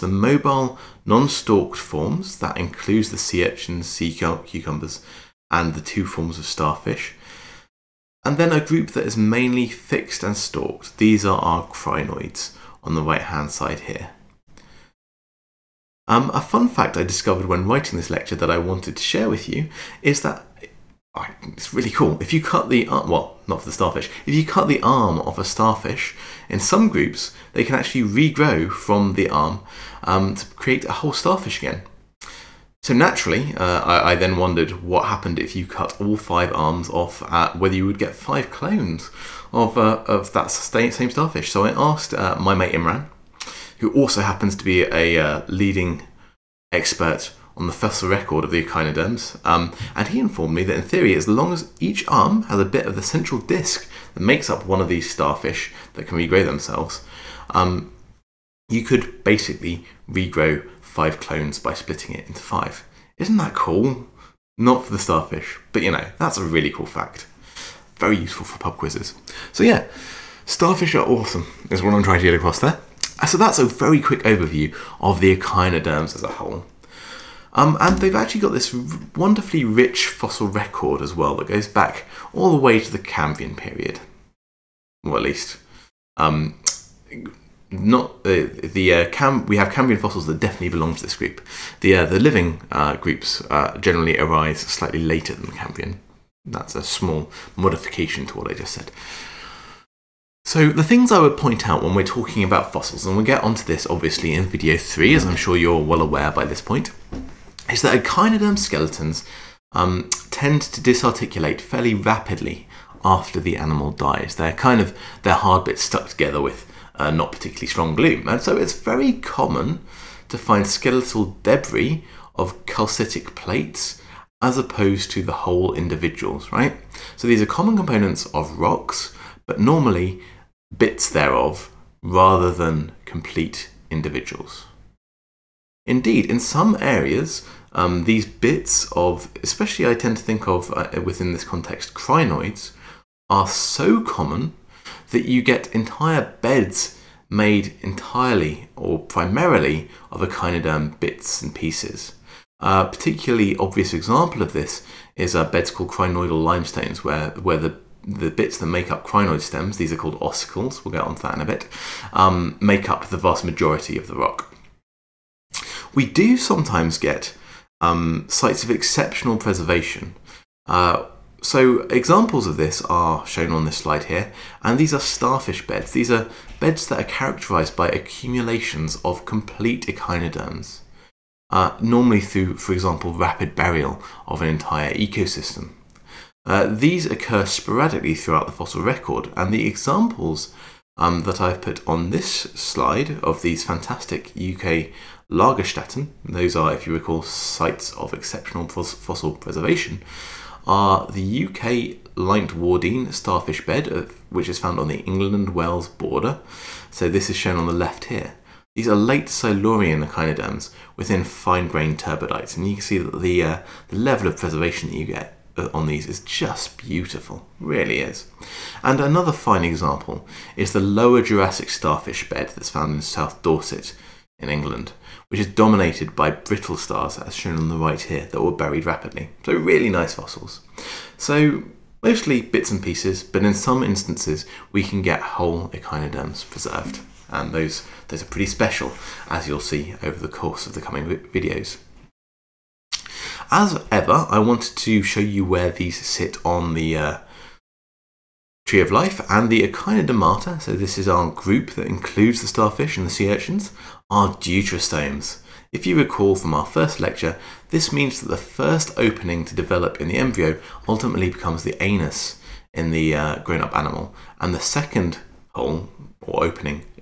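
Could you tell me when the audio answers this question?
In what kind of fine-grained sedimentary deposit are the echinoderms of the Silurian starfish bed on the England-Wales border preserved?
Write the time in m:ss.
3:31.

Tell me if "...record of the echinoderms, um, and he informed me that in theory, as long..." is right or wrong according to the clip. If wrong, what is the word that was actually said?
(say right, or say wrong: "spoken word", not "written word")
right.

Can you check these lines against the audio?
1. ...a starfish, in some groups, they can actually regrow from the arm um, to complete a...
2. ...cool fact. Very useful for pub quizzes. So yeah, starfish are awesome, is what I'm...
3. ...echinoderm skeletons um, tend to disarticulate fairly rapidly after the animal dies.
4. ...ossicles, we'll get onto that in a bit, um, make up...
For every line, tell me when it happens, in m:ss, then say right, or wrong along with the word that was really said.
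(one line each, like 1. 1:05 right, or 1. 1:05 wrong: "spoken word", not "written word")
1. 0:25 wrong: "create", not "complete"
2. 1:06 right
3. 1:48 right
4. 2:40 right.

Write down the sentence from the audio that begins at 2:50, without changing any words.
Uh, so examples of this are shown on this slide here, and these are starfish beds.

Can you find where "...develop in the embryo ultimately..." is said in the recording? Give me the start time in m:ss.
4:19.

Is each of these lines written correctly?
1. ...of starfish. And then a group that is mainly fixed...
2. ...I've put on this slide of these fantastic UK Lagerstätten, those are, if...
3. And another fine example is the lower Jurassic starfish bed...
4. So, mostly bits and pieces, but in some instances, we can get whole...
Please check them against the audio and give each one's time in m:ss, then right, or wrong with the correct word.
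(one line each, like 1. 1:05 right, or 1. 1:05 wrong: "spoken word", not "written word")
1. 0:06 right
2. 3:11 right
3. 3:38 right
4. 3:51 right.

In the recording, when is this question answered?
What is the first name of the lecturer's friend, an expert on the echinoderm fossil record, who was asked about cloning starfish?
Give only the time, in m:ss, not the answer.
0:42.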